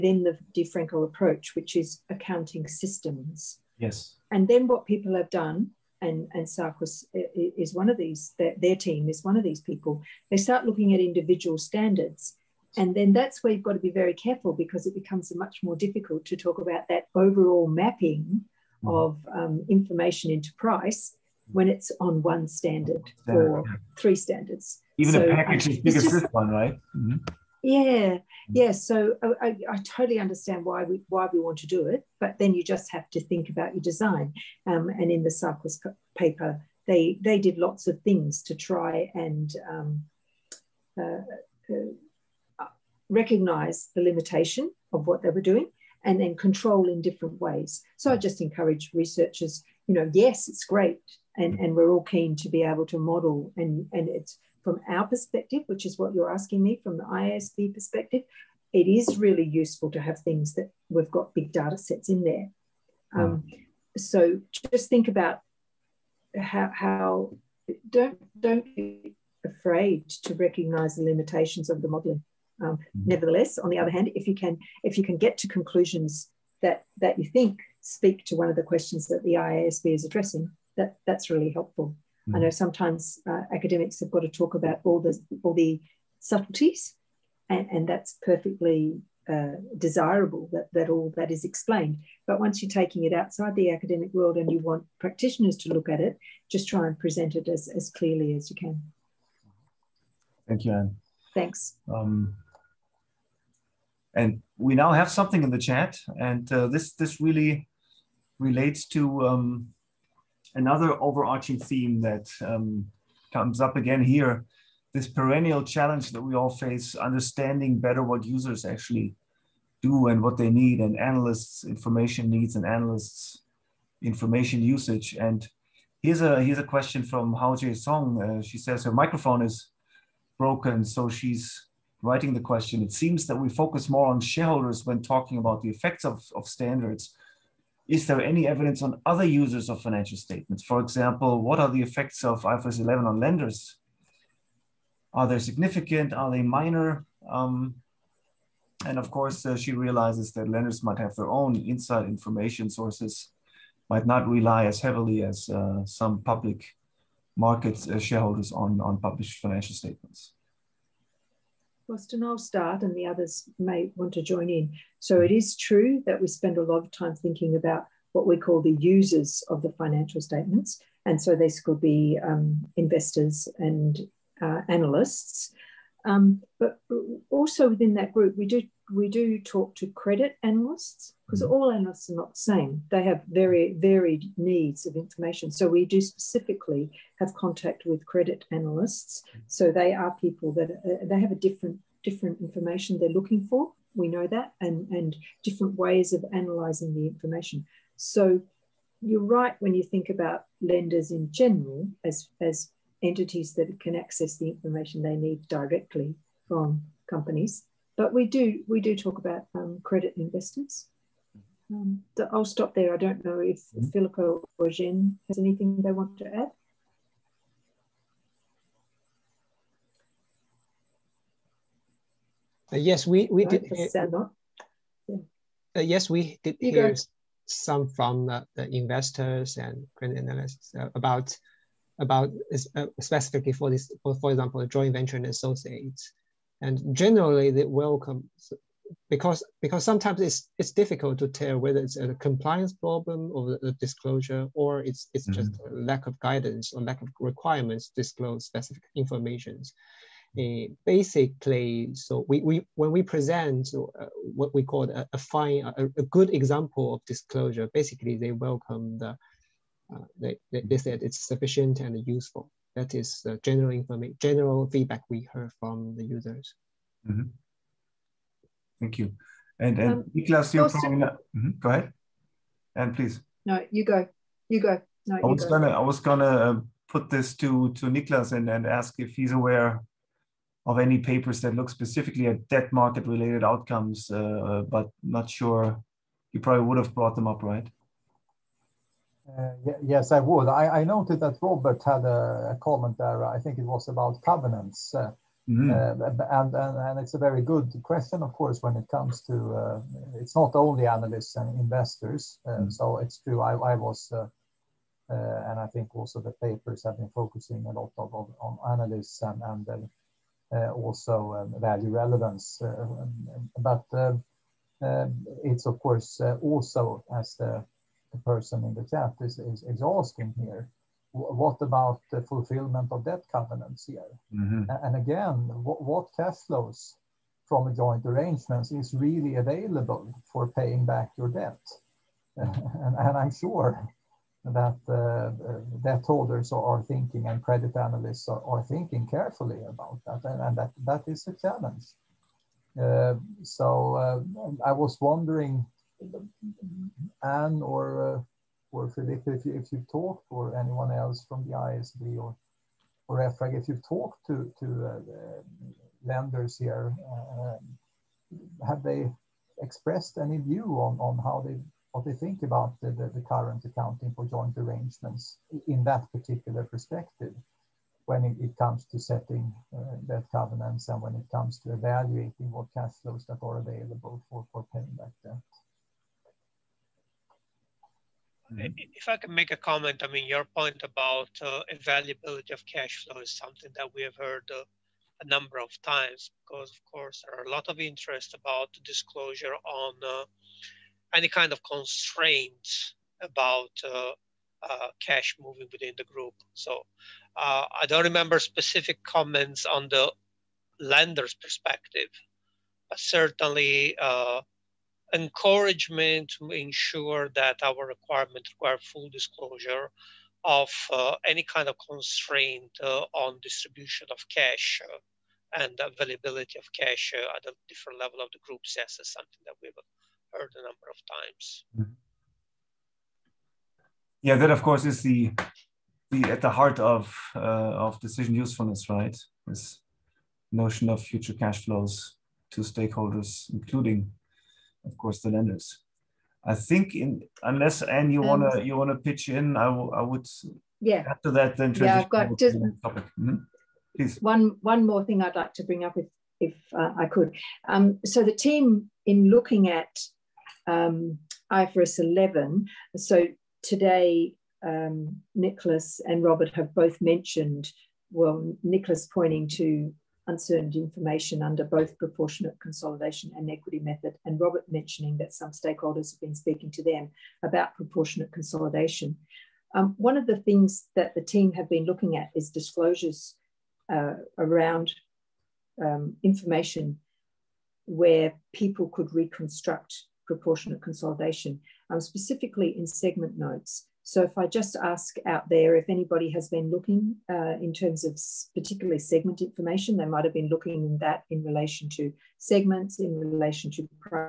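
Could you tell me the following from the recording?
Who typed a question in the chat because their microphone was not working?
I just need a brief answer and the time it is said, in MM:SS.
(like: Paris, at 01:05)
Hao Song, at 02:07.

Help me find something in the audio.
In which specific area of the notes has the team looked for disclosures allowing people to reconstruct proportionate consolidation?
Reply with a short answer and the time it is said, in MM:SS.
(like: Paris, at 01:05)
segment notes, at 08:02.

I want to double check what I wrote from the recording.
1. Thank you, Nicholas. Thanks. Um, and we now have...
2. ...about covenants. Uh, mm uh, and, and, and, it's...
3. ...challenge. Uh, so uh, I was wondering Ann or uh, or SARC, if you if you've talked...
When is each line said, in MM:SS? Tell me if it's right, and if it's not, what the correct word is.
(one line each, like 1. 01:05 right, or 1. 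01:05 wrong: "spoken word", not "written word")
1. 01:40 wrong: "Ann", not "Nicholas"
2. 04:53 right
3. 05:41 wrong: "Frederica", not "SARC".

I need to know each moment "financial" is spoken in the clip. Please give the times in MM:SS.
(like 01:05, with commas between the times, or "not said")
02:19, 02:39, 02:49.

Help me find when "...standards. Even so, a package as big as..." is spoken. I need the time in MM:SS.
00:24.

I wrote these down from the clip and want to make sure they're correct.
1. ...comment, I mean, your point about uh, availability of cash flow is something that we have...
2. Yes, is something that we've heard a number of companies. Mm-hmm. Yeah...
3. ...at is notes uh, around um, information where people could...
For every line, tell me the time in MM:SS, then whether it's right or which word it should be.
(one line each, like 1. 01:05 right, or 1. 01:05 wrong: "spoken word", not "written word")
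1. 06:19 right
2. 06:58 wrong: "times", not "companies"
3. 07:52 wrong: "disclosures", not "notes".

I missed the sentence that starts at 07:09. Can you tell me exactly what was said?
This notion of future cash flows to stakeholders, including of course, the lenders.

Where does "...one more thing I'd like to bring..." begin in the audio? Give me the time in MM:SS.
07:24.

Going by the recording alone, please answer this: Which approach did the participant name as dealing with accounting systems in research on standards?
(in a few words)
the DeFranco approach.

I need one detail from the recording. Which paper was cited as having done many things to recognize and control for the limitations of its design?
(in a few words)
the Cycles paper.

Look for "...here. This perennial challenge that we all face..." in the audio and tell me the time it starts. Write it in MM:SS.
01:54.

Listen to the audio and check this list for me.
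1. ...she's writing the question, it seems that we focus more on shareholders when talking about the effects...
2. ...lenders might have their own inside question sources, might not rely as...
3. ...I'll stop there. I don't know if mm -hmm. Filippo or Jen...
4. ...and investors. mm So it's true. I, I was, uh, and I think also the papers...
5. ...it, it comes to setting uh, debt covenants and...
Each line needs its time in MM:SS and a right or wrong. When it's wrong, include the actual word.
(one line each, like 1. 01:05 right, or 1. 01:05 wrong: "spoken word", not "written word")
1. 02:11 right
2. 02:30 wrong: "information", not "question"
3. 03:32 right
4. 05:01 right
5. 06:08 right.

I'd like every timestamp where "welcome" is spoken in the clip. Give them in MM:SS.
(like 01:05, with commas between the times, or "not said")
03:57, 04:18.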